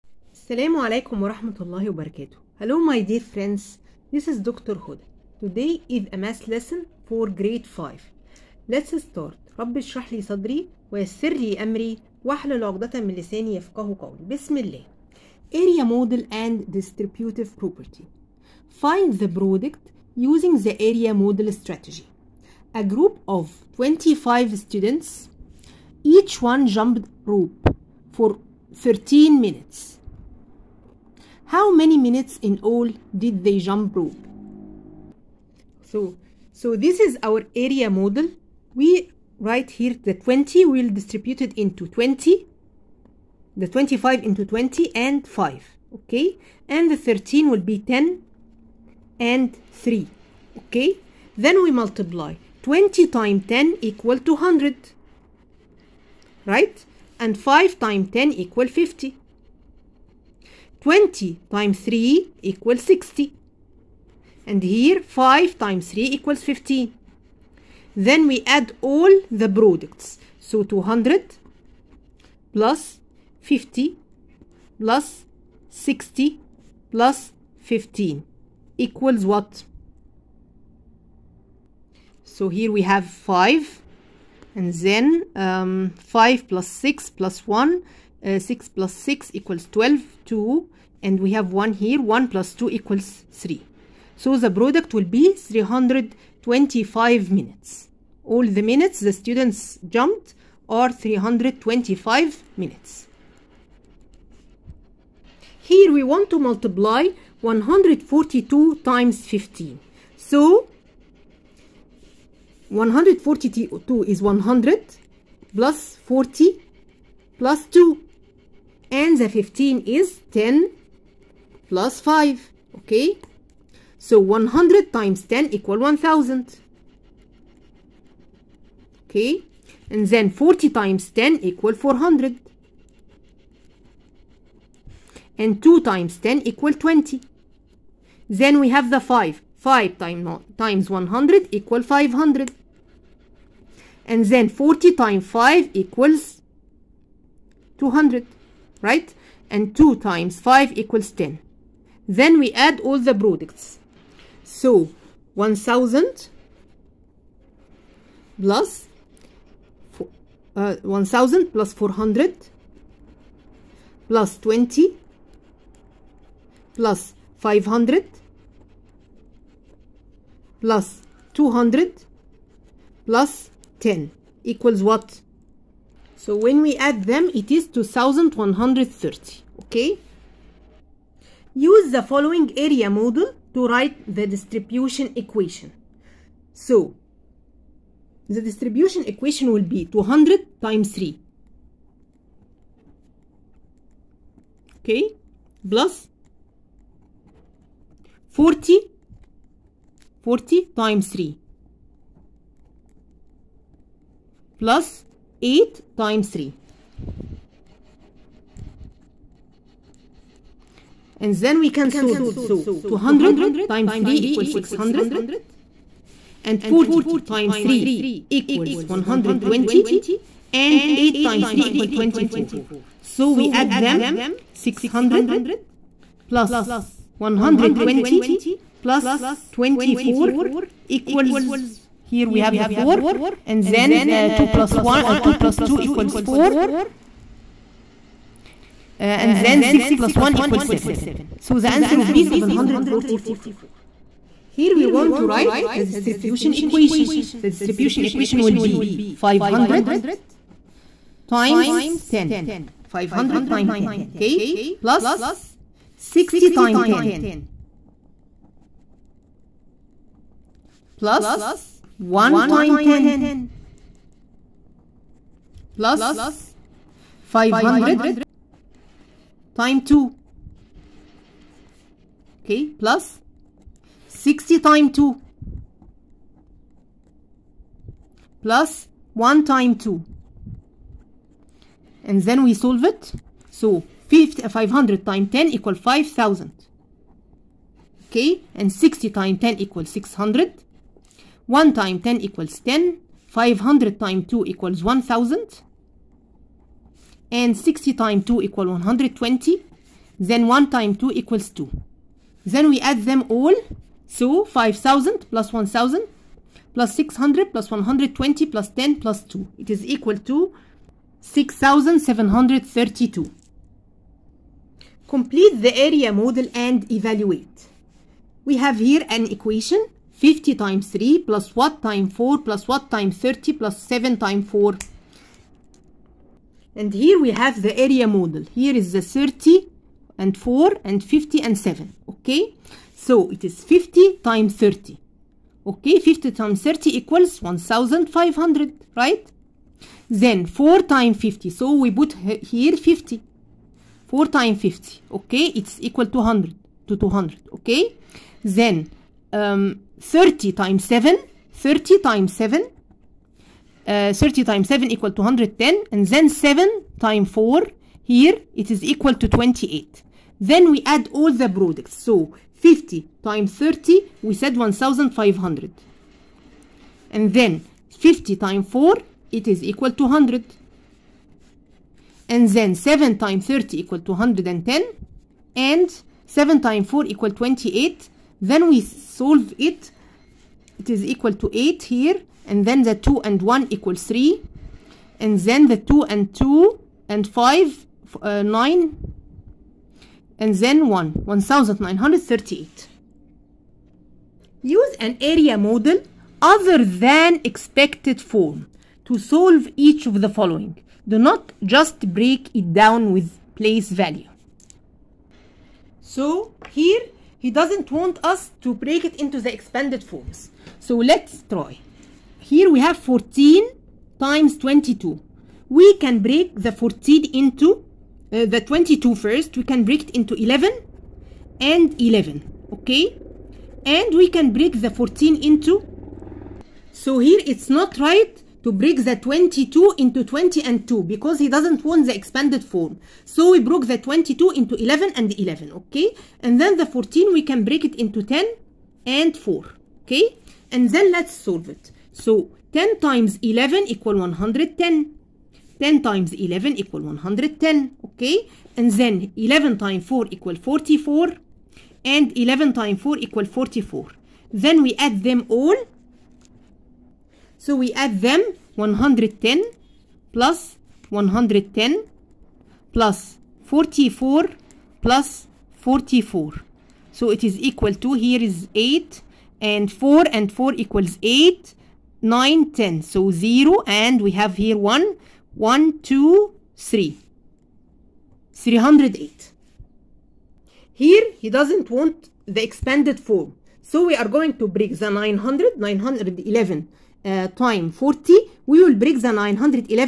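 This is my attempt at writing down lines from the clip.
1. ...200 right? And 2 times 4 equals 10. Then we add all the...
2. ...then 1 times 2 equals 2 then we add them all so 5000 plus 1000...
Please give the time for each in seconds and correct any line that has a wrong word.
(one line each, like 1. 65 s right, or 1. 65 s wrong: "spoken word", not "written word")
1. 147 s wrong: "5", not "4"
2. 300 s right.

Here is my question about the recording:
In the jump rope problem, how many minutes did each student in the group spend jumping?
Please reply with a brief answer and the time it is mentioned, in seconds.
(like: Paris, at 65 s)
13, at 28 s.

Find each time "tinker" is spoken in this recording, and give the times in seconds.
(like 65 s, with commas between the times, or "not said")
not said.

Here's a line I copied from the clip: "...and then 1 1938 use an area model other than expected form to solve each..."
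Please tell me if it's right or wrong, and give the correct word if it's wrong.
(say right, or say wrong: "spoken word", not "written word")
right.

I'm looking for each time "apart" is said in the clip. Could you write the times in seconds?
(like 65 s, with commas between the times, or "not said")
not said.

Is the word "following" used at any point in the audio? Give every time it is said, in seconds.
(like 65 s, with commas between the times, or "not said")
182 s, 400 s.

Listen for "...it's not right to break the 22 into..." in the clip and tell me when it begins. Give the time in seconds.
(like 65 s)
427 s.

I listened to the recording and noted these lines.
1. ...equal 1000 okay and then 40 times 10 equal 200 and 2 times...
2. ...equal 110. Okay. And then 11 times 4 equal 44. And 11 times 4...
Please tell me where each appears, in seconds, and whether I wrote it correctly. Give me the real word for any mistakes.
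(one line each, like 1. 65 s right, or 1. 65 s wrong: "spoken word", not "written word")
1. 125 s wrong: "400", not "200"
2. 446 s right.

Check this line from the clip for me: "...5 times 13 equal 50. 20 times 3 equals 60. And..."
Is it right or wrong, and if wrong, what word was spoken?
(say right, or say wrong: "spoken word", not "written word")
wrong: "10", not "13".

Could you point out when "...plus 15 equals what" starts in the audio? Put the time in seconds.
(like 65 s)
76 s.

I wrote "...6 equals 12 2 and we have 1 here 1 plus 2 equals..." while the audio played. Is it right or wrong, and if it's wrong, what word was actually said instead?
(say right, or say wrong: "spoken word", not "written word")
right.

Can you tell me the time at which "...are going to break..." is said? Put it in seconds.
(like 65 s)
484 s.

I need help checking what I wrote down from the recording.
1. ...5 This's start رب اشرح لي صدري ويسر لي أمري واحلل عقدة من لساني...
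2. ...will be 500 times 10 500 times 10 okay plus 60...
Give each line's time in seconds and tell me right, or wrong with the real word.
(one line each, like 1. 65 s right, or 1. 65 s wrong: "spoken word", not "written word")
1. 7 s wrong: "Let", not "This"
2. 248 s right.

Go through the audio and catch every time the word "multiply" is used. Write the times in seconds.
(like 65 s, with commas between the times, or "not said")
51 s, 106 s.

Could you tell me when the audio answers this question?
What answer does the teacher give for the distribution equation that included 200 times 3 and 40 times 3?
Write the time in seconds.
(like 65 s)
242 s.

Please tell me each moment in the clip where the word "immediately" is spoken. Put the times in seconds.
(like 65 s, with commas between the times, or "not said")
not said.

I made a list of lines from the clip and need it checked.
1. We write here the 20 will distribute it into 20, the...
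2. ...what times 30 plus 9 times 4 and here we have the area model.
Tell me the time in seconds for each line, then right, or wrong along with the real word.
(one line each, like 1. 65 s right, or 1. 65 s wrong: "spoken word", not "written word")
1. 38 s right
2. 322 s wrong: "7", not "9".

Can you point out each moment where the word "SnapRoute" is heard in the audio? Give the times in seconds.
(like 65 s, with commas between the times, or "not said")
not said.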